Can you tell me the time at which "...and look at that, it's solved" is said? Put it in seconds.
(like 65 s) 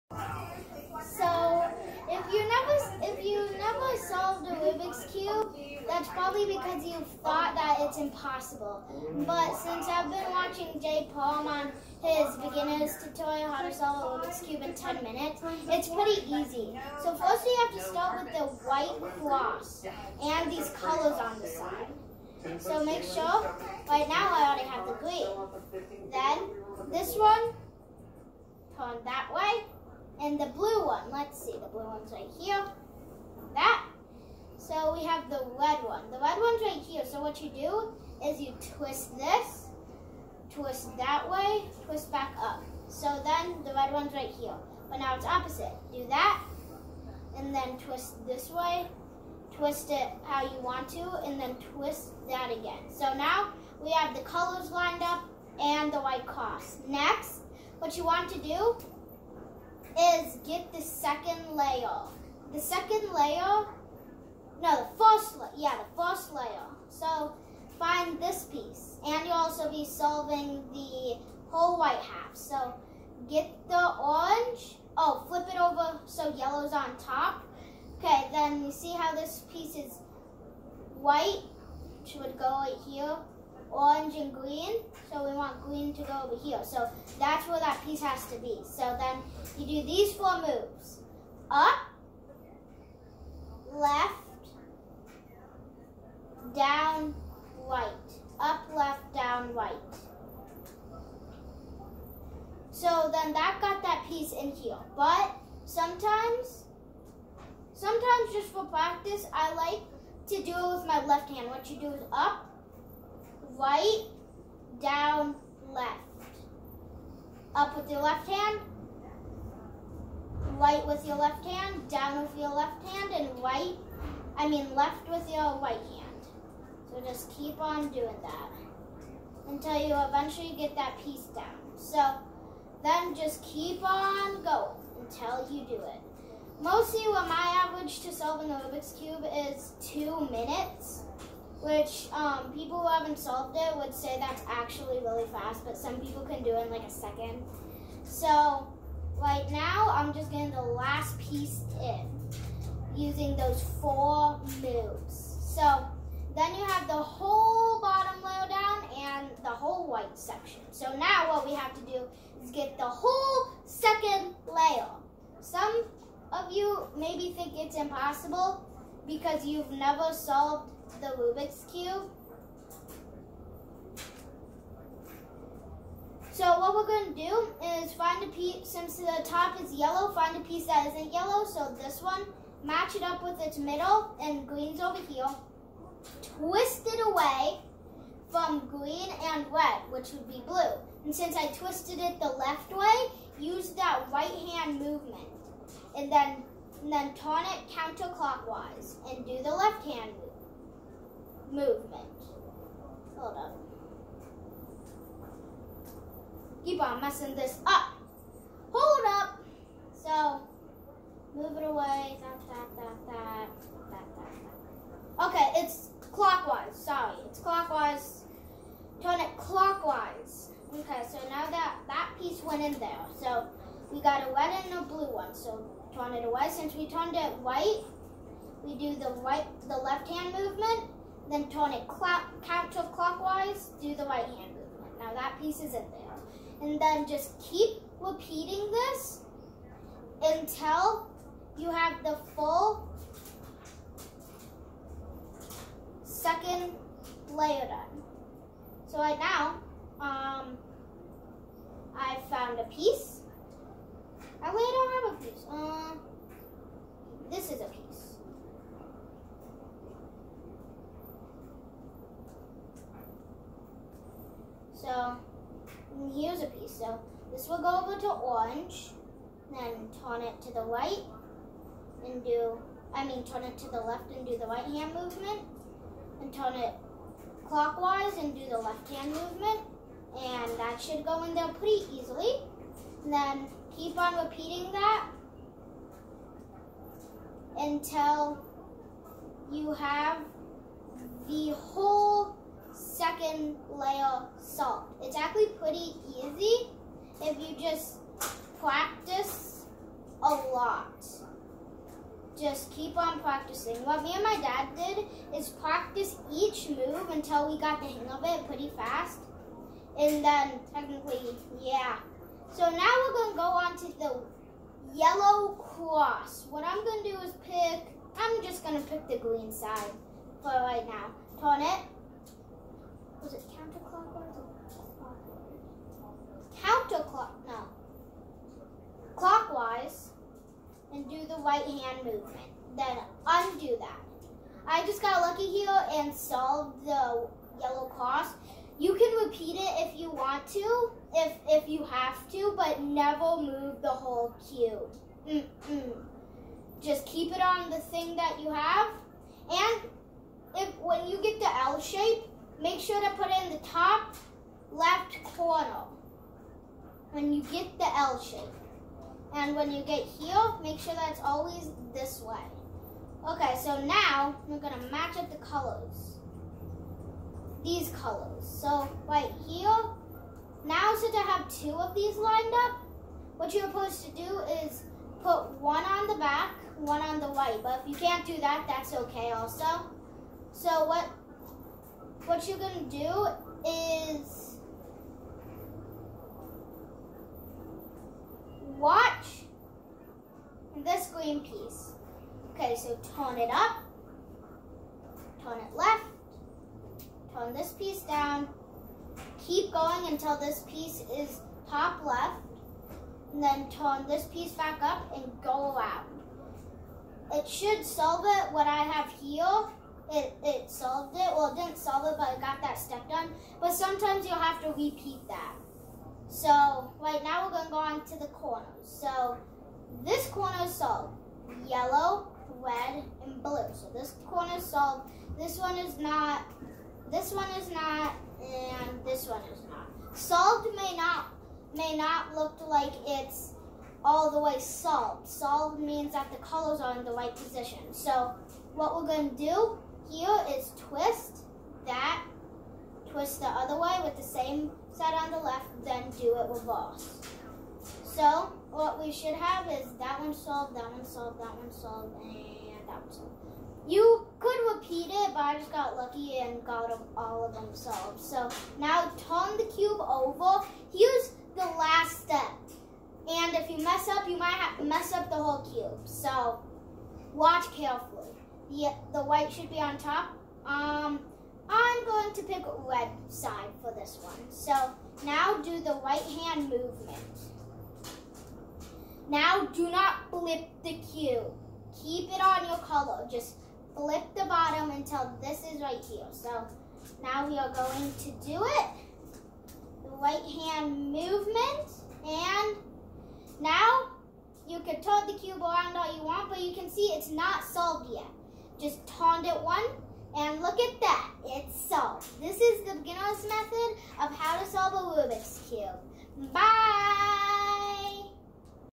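500 s.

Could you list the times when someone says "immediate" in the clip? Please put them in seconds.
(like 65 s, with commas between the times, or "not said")
not said.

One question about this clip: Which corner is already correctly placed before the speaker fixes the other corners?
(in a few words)
yellow, red, and blue.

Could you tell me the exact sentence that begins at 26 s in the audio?
Then this one, turn that way, and the blue one, let's see, the blue one's right here that.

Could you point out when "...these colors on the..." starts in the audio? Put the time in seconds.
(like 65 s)
20 s.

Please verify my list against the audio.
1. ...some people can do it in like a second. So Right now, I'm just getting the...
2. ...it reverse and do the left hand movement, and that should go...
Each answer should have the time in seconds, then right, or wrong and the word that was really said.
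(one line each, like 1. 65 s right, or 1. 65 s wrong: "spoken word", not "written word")
1. 145 s right
2. 276 s wrong: "clockwise", not "reverse".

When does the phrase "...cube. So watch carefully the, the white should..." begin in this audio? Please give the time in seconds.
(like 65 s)
465 s.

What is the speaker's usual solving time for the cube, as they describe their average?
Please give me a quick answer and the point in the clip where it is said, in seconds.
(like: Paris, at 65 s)
2 minutes, at 139 s.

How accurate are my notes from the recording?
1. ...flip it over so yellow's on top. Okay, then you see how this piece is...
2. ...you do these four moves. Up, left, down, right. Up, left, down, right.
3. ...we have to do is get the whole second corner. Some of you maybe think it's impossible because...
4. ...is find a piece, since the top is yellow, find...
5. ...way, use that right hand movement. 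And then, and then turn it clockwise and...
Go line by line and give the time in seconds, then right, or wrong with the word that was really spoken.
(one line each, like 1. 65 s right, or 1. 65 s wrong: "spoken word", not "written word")
1. 75 s right
2. 89 s right
3. 161 s wrong: "layer", not "corner"
4. 177 s right
5. 192 s wrong: "counterclockwise", not "clockwise".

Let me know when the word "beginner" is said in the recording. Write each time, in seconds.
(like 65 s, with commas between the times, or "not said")
12 s, 502 s.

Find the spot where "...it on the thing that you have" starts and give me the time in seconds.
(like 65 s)
347 s.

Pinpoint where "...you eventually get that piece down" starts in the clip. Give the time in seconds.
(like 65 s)
129 s.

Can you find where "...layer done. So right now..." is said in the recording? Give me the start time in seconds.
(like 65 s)
247 s.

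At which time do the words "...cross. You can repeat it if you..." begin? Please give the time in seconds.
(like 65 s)
337 s.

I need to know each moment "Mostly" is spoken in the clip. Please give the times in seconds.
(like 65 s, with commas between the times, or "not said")
136 s.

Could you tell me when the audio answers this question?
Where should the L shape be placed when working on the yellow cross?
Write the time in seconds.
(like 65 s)
353 s.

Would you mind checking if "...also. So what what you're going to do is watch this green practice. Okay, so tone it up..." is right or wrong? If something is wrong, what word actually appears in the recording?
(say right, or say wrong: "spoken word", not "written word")
wrong: "piece", not "practice".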